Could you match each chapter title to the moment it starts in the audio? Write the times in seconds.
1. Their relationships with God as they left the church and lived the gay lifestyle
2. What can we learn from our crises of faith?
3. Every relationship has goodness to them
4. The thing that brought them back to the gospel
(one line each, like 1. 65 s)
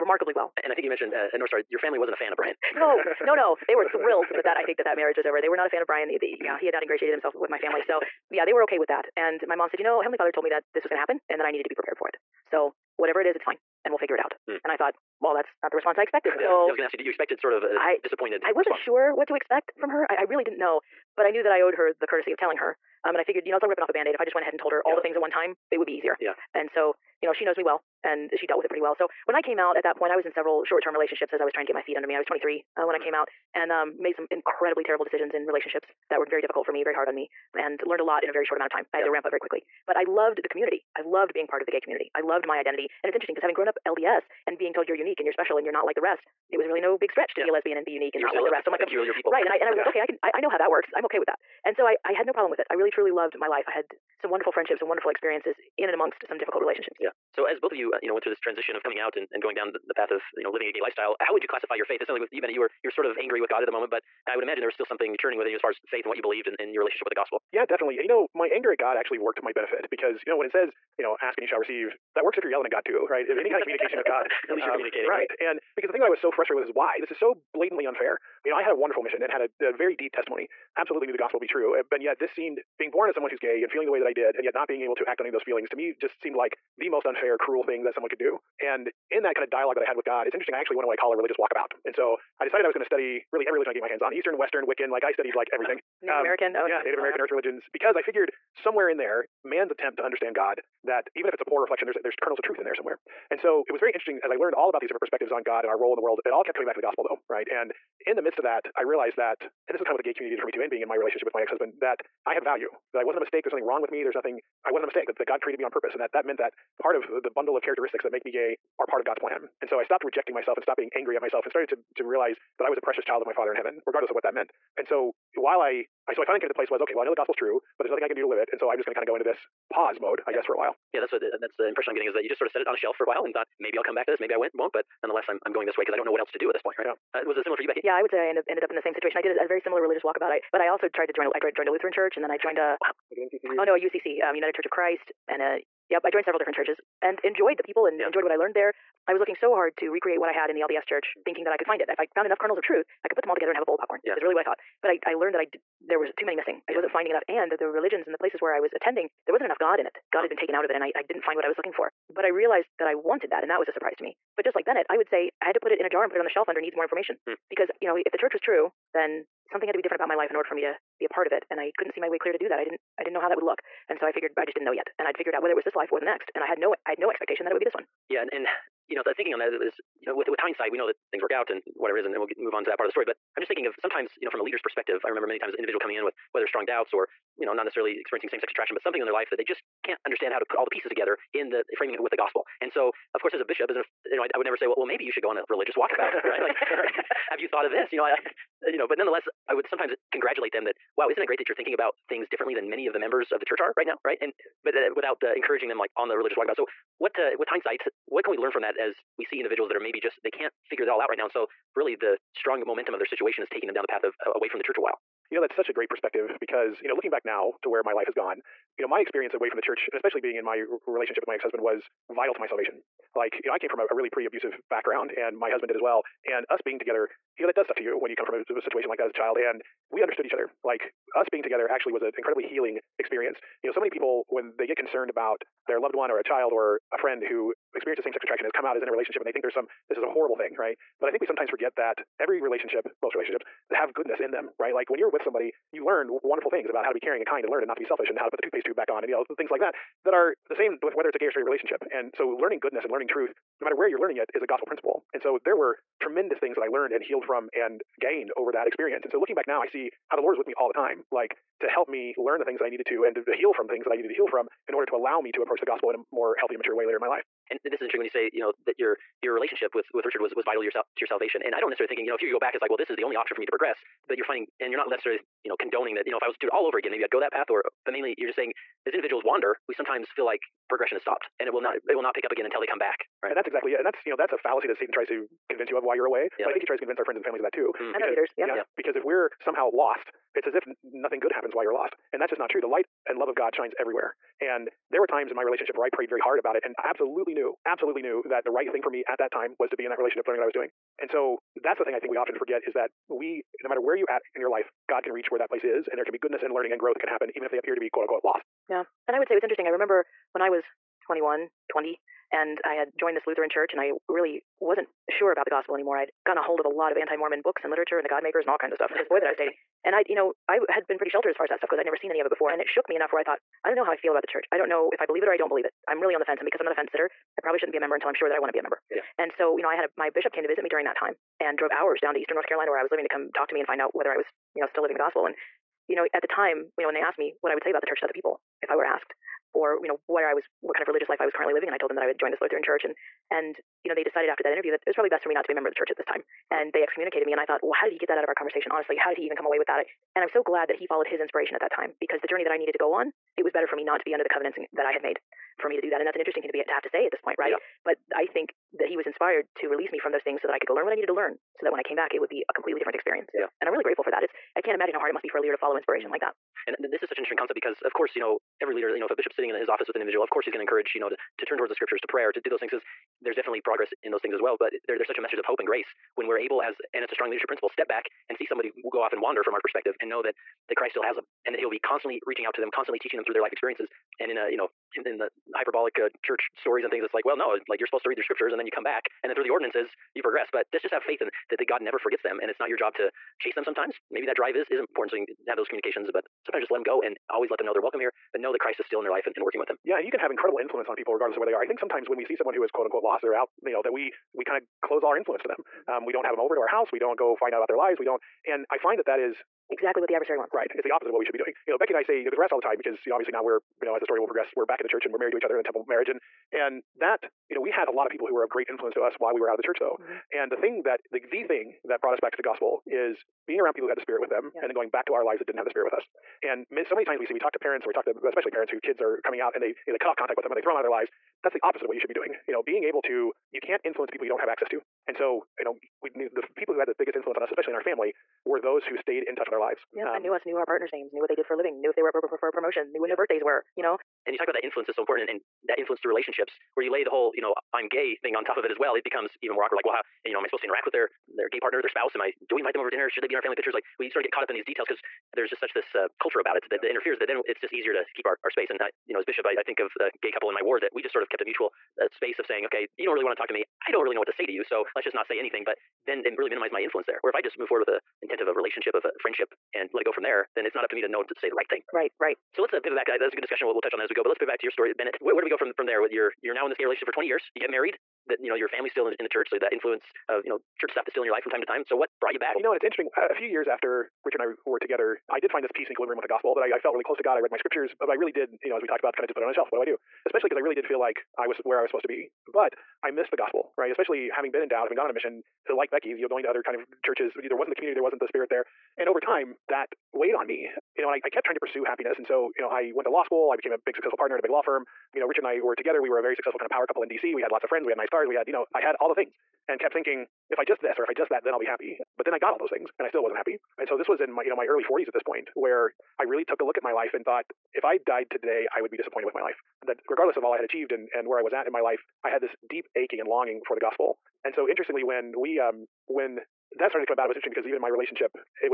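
1. 73 s
2. 221 s
3. 253 s
4. 434 s.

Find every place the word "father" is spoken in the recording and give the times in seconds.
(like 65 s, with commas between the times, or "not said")
10 s, 123 s.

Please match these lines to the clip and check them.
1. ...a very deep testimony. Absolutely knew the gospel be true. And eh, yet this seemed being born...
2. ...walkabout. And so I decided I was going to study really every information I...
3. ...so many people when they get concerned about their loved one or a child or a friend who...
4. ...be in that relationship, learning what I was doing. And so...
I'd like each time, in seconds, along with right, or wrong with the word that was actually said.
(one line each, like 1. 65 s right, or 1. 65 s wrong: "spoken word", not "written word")
1. 79 s right
2. 91 s wrong: "religion", not "information"
3. 233 s right
4. 299 s right.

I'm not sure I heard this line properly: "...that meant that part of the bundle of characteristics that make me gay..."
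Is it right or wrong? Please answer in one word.
right.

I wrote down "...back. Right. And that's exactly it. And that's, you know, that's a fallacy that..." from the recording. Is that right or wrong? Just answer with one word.
right.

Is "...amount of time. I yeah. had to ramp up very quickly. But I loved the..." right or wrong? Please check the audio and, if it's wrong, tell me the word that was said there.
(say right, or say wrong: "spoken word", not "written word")
right.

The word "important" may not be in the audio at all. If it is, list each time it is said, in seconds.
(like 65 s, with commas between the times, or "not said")
394 s, 445 s.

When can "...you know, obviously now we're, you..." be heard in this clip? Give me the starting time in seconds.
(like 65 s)
413 s.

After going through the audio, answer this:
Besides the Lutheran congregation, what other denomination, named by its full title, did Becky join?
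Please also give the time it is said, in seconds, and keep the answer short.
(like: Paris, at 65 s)
United Church of Christ, at 144 s.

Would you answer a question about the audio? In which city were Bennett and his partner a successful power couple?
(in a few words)
DC.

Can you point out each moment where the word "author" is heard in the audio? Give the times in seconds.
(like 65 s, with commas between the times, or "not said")
not said.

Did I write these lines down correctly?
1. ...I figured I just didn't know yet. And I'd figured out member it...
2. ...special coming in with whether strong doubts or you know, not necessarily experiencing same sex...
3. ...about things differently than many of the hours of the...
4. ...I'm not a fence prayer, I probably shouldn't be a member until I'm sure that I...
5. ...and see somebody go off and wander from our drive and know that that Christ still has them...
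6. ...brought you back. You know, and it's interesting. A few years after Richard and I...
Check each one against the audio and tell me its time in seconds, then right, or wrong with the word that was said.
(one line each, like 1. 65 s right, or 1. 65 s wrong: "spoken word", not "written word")
1. 174 s wrong: "whether", not "member"
2. 185 s wrong: "individual", not "special"
3. 201 s wrong: "members", not "hours"
4. 326 s wrong: "sitter", not "prayer"
5. 378 s wrong: "perspective", not "drive"
6. 482 s right.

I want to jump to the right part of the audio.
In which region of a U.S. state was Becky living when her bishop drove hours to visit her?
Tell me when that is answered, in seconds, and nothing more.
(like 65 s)
332 s.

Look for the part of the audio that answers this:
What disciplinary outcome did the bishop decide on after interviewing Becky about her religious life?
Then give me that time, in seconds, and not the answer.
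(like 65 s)
346 s.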